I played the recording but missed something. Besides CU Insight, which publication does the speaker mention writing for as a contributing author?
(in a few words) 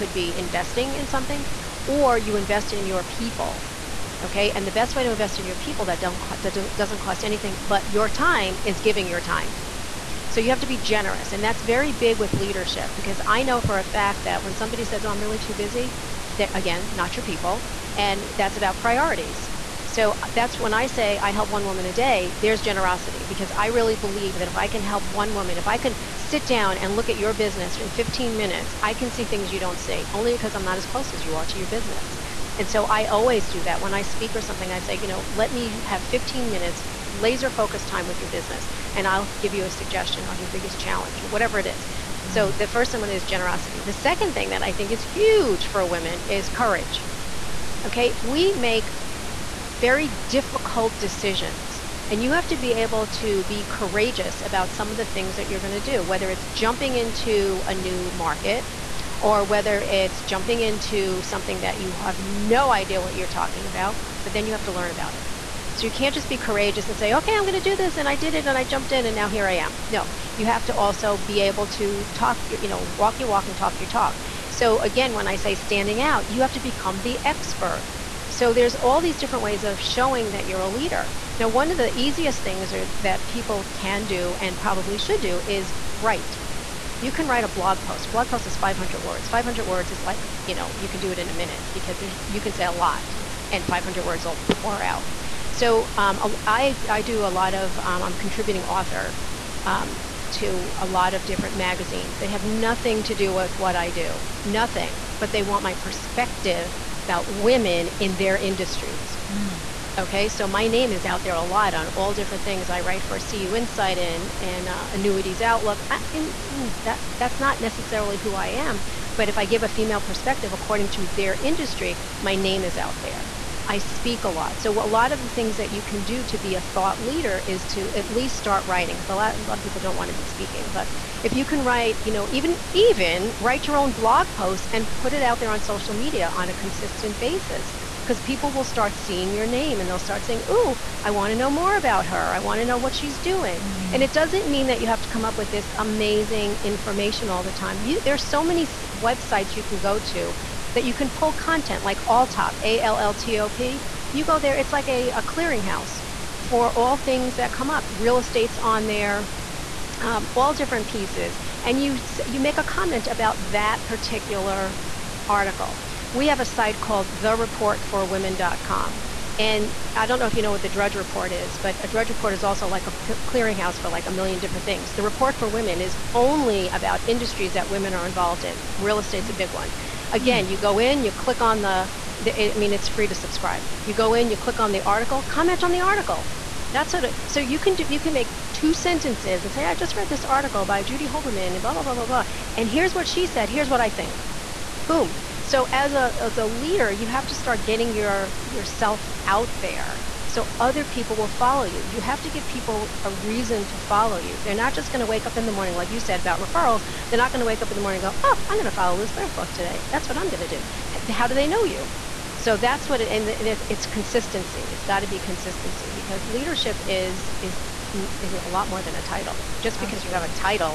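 Annuities Outlook.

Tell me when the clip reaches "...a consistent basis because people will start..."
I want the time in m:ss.
2:16.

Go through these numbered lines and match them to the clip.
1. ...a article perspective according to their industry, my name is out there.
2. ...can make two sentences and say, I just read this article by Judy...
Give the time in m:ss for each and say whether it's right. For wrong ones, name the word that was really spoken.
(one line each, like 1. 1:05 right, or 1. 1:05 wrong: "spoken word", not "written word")
1. 1:59 wrong: "female", not "article"
2. 3:07 right.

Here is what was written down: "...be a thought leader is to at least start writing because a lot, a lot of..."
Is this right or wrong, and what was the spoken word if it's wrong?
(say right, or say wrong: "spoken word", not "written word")
right.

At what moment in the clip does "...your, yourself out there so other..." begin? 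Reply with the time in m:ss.
3:17.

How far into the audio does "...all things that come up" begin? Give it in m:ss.
2:36.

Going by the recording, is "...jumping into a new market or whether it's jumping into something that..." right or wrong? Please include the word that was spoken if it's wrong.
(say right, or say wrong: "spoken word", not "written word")
right.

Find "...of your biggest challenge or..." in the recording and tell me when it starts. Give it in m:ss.
0:40.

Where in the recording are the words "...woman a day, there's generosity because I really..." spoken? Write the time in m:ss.
0:21.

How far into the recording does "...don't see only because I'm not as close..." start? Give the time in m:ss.
0:29.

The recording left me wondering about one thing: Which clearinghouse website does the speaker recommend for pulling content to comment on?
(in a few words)
Alltop.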